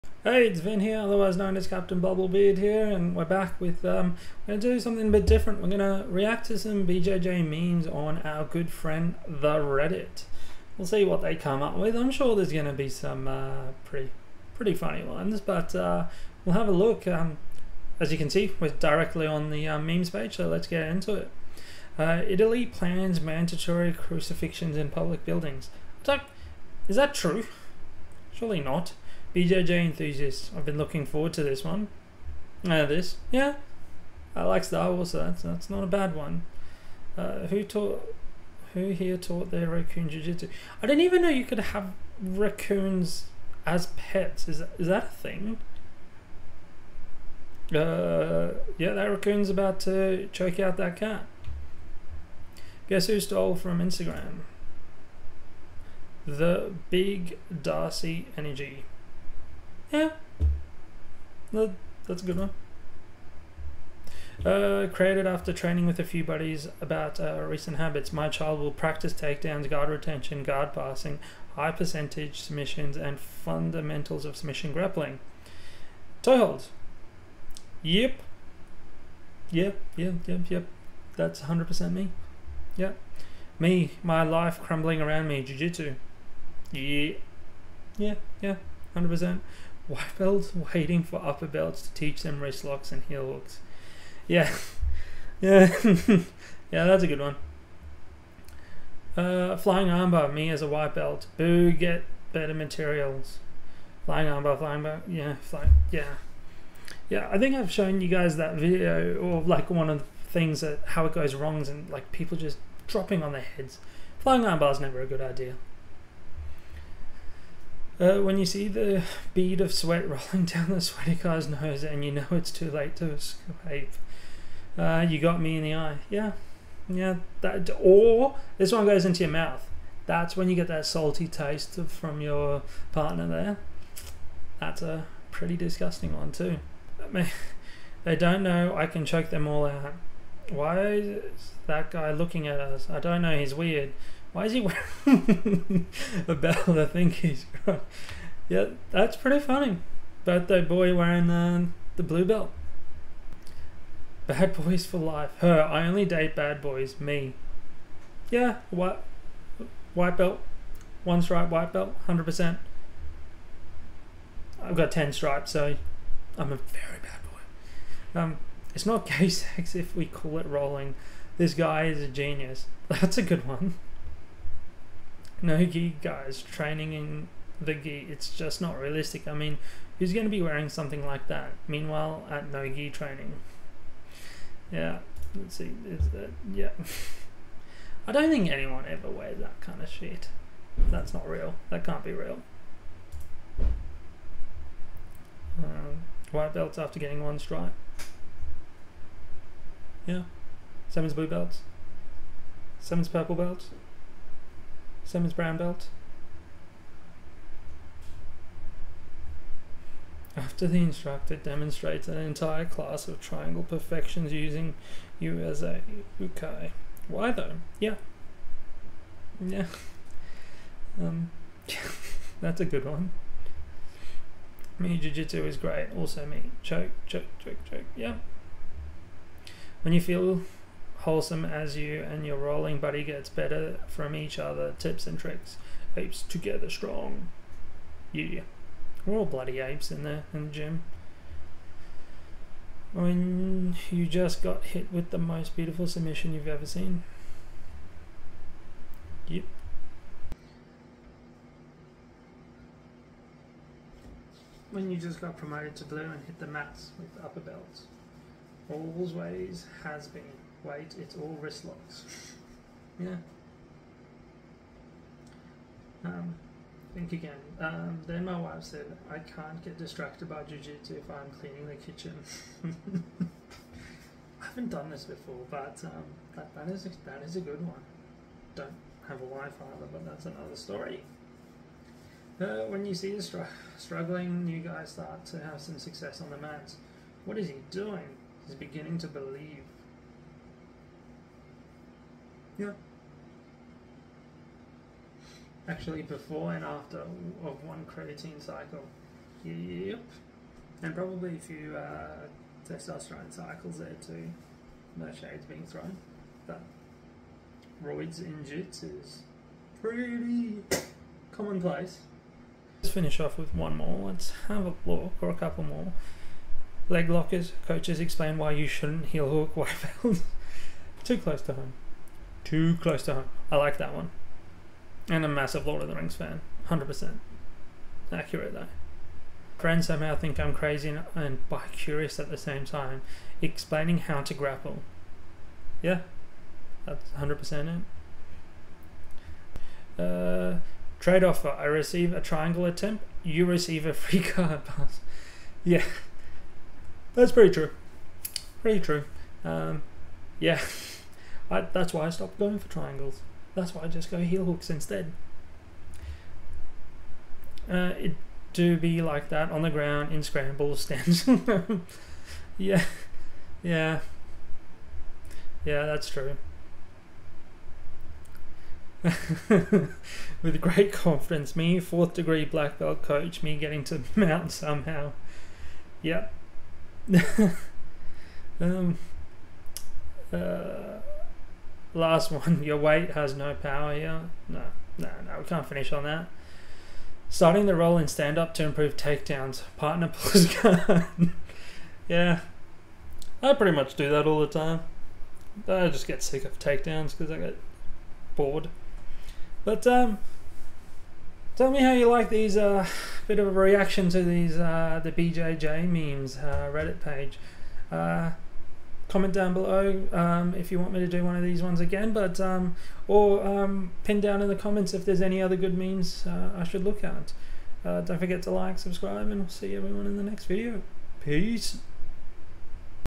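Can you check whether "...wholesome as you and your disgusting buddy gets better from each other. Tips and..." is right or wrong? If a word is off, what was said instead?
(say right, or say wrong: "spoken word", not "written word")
wrong: "rolling", not "disgusting".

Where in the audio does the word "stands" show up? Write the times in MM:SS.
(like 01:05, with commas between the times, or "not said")
06:00, 06:28.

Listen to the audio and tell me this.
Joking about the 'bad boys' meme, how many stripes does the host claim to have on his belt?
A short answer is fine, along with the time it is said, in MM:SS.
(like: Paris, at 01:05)
10, at 02:44.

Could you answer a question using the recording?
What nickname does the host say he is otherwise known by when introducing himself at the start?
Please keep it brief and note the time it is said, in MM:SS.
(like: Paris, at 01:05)
Captain Bubblebeard, at 00:01.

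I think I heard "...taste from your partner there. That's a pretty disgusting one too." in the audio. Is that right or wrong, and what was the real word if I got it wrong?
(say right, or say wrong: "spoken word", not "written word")
right.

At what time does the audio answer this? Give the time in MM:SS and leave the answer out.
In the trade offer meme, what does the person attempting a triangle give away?
05:43.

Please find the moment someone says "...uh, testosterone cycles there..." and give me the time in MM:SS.
05:01.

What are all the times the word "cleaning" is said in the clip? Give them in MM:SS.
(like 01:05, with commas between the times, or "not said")
04:31.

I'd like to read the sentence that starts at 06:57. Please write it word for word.
Uh, don't forget to like, subscribe, and we'll see everyone in the next video.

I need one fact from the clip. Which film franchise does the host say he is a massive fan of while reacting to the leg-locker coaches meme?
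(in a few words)
Lord of the Rings.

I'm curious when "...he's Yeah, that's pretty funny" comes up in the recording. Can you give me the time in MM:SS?
02:27.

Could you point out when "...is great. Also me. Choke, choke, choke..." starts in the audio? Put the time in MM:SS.
03:45.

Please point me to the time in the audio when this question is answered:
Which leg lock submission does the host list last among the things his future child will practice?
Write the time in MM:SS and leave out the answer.
01:16.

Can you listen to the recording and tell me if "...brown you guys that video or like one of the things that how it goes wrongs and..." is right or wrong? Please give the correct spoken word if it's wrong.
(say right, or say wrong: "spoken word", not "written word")
wrong: "shown", not "brown".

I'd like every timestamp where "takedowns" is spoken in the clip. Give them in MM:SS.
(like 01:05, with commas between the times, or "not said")
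01:09, 06:28, 06:36.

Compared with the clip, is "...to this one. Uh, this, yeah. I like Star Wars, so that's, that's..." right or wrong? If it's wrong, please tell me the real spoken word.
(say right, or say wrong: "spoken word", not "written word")
right.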